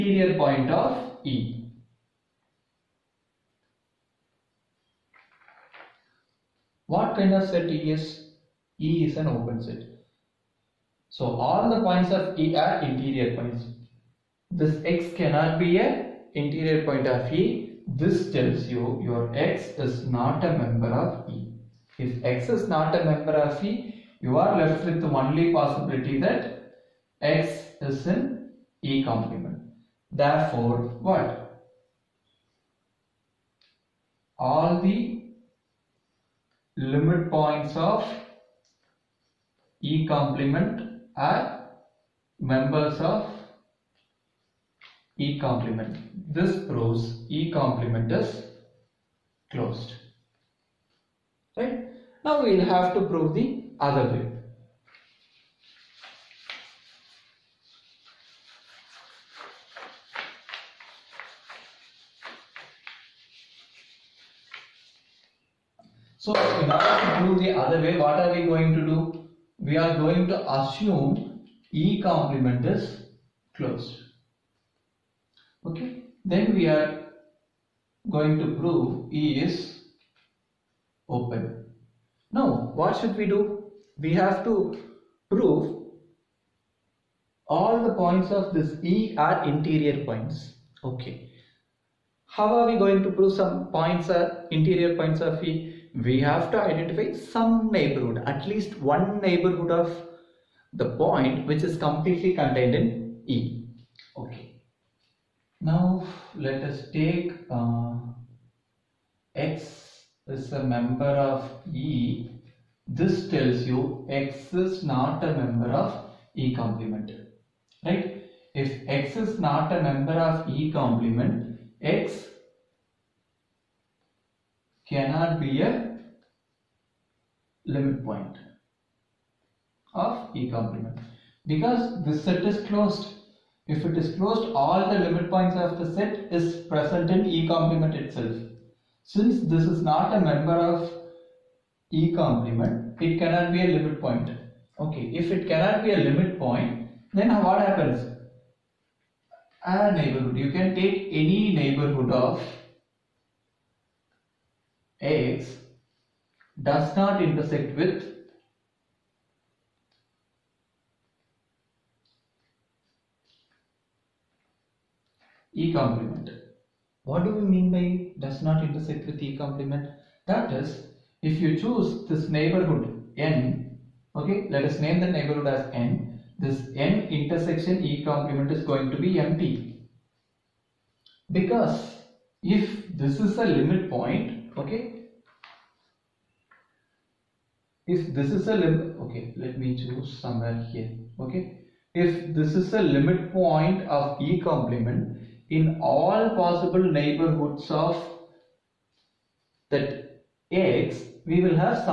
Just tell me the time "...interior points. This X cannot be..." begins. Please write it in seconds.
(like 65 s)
12 s.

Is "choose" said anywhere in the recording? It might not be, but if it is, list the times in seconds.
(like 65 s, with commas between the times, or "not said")
171 s, 189 s.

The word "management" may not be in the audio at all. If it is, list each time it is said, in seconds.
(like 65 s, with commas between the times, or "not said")
not said.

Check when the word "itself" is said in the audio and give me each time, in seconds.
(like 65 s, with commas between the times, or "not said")
137 s.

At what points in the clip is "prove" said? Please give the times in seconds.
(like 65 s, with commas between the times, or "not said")
46 s, 53 s, 78 s, 85 s, 93 s.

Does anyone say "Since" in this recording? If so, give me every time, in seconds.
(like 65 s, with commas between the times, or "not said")
139 s.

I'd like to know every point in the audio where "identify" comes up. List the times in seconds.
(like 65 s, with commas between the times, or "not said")
96 s.